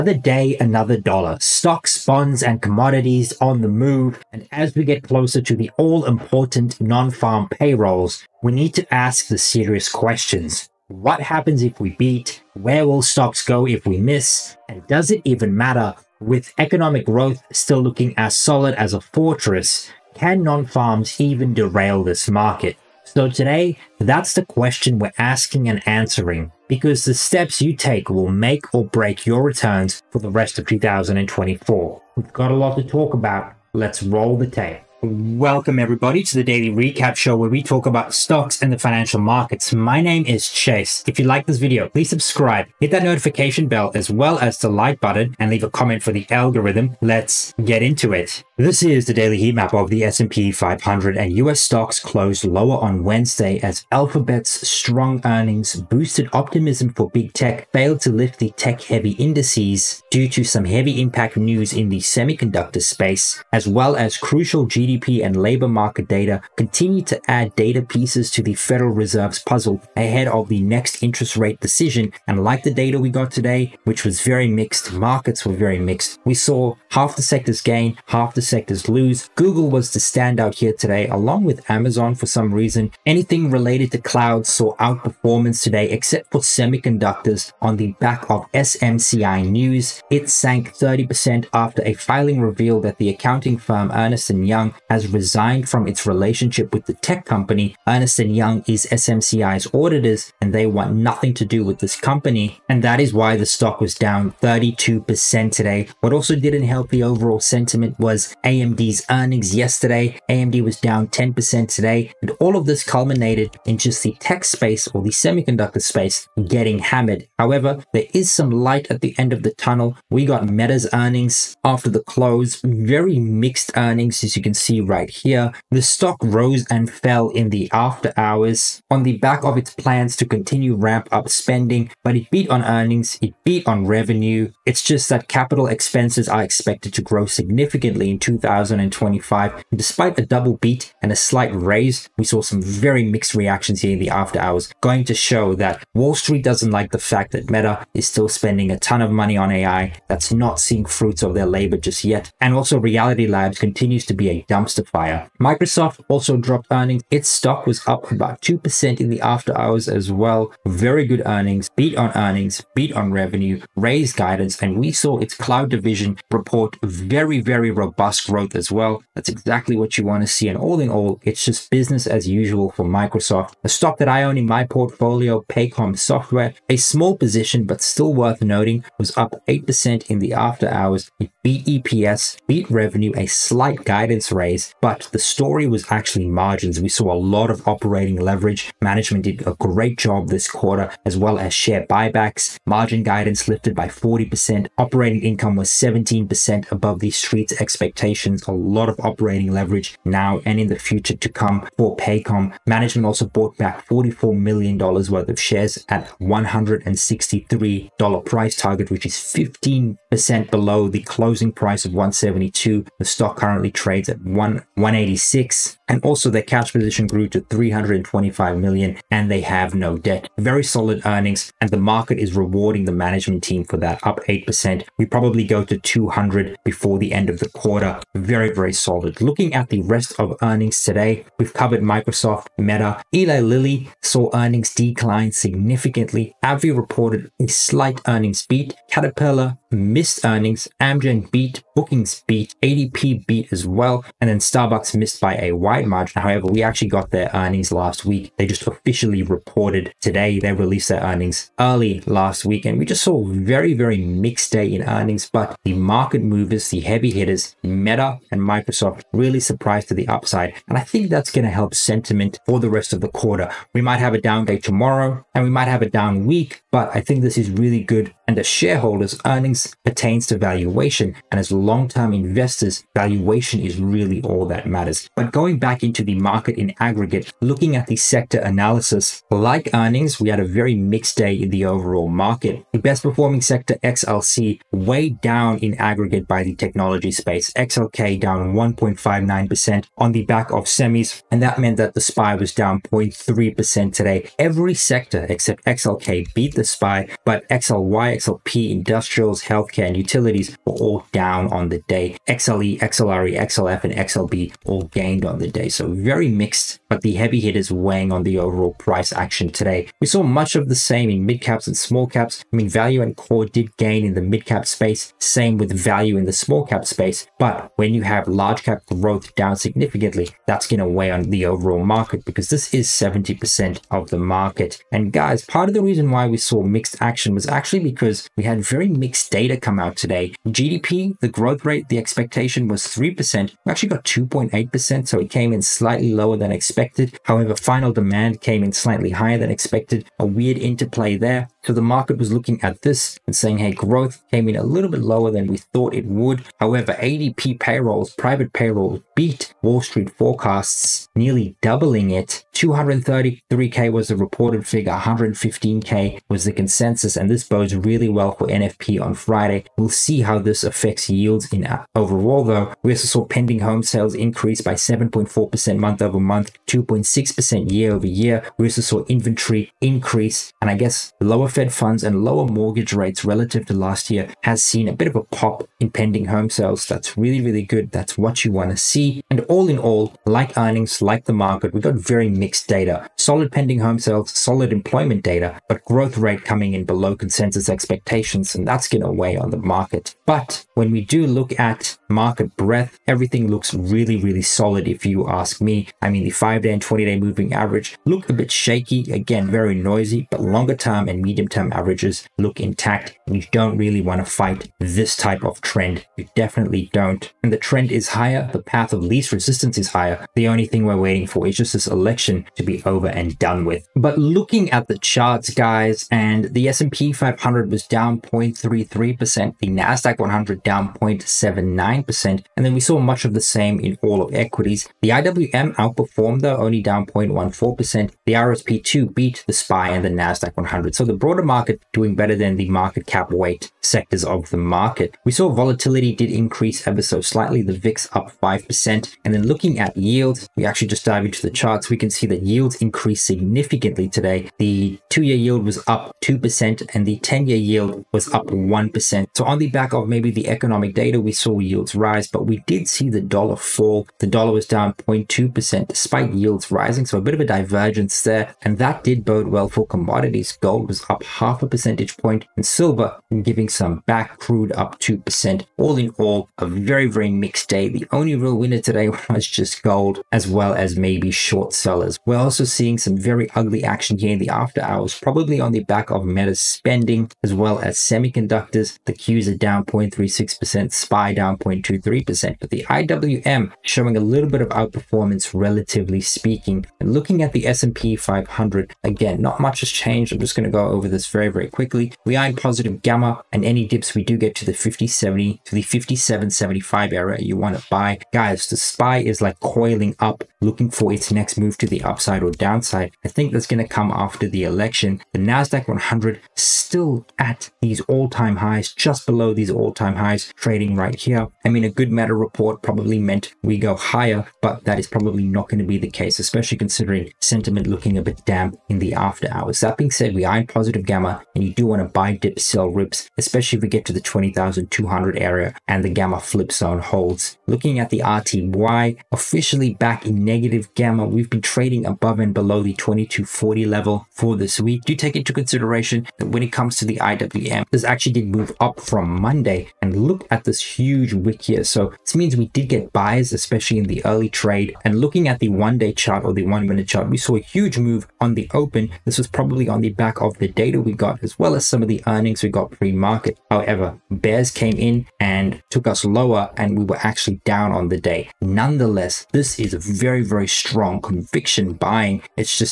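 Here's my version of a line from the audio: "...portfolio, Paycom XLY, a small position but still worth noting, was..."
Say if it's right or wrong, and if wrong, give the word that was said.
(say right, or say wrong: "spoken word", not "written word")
wrong: "Software", not "XLY".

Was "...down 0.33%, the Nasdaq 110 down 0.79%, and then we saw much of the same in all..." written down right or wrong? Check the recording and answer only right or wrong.
wrong.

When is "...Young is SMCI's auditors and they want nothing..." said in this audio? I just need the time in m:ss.
1:38.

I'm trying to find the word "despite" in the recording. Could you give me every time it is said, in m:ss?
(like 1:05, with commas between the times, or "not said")
2:19, 7:35.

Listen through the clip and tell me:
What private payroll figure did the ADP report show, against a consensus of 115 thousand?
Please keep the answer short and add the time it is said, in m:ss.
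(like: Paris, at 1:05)
233K, at 5:52.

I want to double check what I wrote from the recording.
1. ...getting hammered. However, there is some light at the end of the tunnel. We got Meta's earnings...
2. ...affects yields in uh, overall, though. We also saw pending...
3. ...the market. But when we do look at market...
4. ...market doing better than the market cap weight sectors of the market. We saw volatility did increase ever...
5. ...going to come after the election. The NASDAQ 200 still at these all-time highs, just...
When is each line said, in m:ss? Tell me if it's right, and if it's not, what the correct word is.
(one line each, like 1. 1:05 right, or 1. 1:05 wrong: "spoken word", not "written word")
1. 1:56 right
2. 6:00 right
3. 6:29 right
4. 7:11 right
5. 8:23 wrong: "100", not "200".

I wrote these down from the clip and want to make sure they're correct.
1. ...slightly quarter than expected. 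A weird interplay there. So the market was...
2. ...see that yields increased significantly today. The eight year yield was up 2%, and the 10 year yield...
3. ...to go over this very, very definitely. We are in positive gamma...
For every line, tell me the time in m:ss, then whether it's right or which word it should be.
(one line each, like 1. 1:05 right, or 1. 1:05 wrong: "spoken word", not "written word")
1. 5:38 wrong: "higher", not "quarter"
2. 7:22 wrong: "two", not "eight"
3. 8:10 wrong: "quickly", not "definitely".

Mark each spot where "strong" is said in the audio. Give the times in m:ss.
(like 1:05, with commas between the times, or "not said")
0:54, 9:20.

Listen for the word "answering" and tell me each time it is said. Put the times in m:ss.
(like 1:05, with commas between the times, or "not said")
0:25.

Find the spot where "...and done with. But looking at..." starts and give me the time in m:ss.
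6:53.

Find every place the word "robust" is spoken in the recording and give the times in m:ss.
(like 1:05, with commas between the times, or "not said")
2:47.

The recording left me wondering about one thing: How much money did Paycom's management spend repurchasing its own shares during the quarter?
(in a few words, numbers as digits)
$44 million.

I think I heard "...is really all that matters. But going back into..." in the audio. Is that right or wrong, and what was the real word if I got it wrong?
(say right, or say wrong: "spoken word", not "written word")
right.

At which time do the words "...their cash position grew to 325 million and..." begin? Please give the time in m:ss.
3:36.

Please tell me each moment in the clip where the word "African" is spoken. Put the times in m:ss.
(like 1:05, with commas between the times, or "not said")
not said.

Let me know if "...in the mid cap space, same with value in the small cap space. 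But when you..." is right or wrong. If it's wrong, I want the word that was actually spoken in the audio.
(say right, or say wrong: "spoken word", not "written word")
right.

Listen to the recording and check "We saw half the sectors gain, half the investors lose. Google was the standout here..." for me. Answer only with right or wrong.
wrong.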